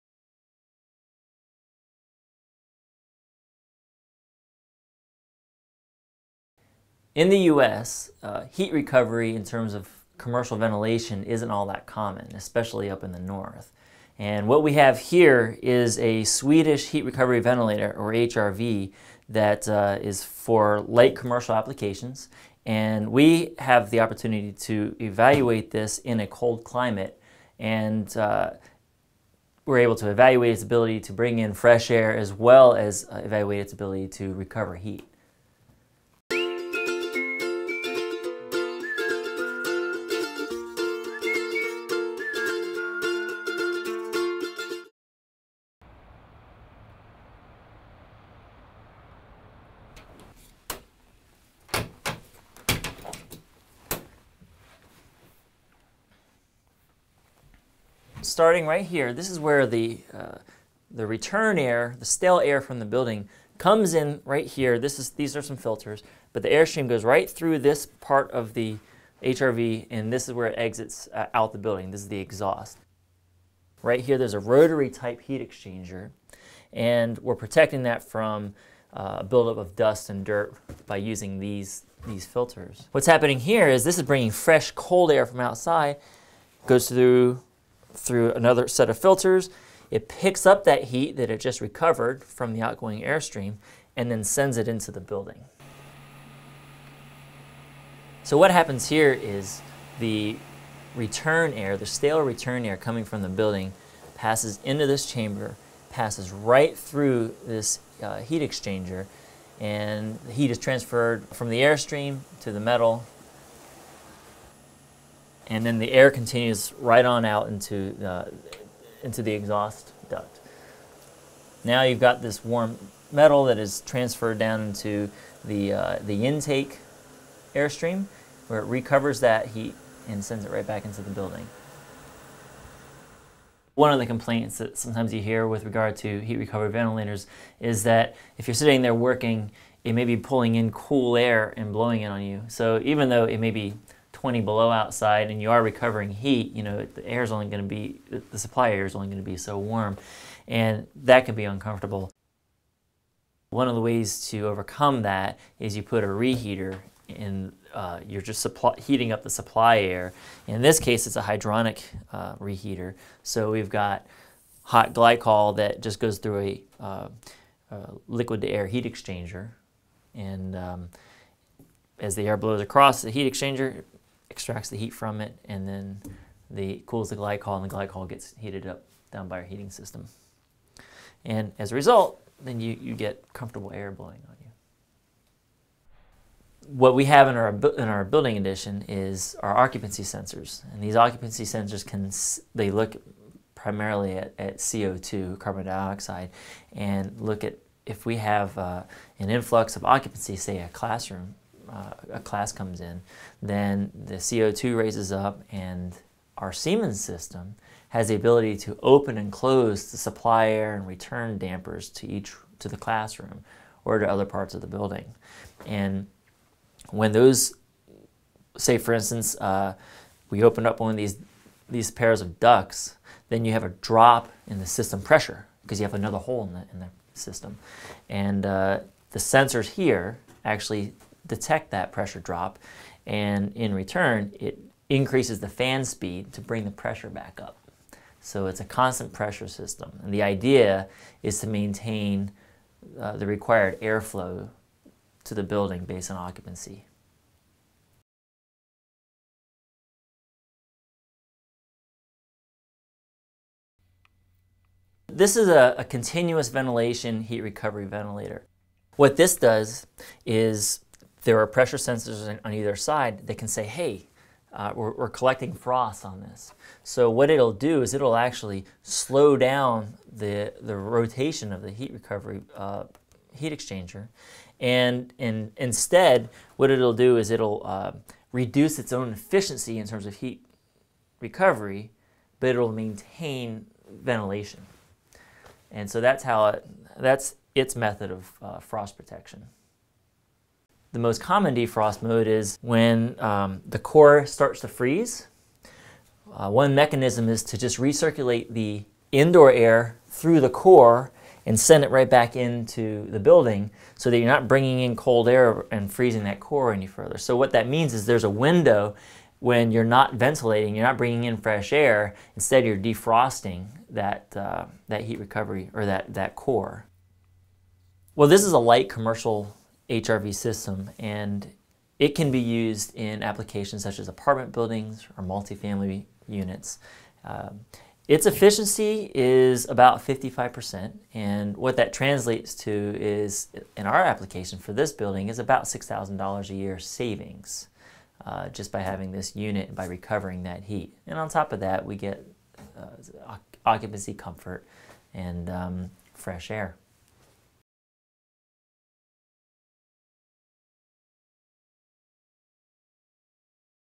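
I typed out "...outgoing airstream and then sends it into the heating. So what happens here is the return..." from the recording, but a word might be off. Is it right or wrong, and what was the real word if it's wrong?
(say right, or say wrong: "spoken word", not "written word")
wrong: "building", not "heating".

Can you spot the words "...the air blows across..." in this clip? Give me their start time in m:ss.
2:52.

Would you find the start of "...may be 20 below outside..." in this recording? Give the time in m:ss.
2:23.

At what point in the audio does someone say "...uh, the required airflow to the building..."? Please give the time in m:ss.
4:02.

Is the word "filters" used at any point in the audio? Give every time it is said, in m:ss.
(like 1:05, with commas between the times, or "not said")
1:05, 1:22, 1:28.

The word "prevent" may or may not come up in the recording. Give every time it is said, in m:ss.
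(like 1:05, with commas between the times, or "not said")
not said.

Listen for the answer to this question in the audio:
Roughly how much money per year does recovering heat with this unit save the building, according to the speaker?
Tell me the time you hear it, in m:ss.
5:35.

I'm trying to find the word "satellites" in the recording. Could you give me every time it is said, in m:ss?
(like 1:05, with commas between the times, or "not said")
not said.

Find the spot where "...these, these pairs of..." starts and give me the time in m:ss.
3:40.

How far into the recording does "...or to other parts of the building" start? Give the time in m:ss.
3:33.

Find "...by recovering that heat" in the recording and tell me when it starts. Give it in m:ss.
5:39.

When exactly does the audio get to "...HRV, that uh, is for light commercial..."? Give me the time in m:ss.
0:18.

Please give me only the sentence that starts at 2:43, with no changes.
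So we've got hot glycol that just goes through a, uh, a liquid to air heat exchanger.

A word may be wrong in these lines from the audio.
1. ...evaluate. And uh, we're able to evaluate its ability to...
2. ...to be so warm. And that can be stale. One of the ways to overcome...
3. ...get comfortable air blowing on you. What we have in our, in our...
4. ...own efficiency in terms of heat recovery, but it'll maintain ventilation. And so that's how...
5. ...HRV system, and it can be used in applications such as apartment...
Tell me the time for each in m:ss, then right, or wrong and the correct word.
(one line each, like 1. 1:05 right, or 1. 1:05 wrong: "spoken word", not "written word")
1. 0:26 wrong: "climate", not "evaluate"
2. 2:29 wrong: "uncomfortable", not "stale"
3. 3:02 right
4. 4:38 right
5. 5:19 right.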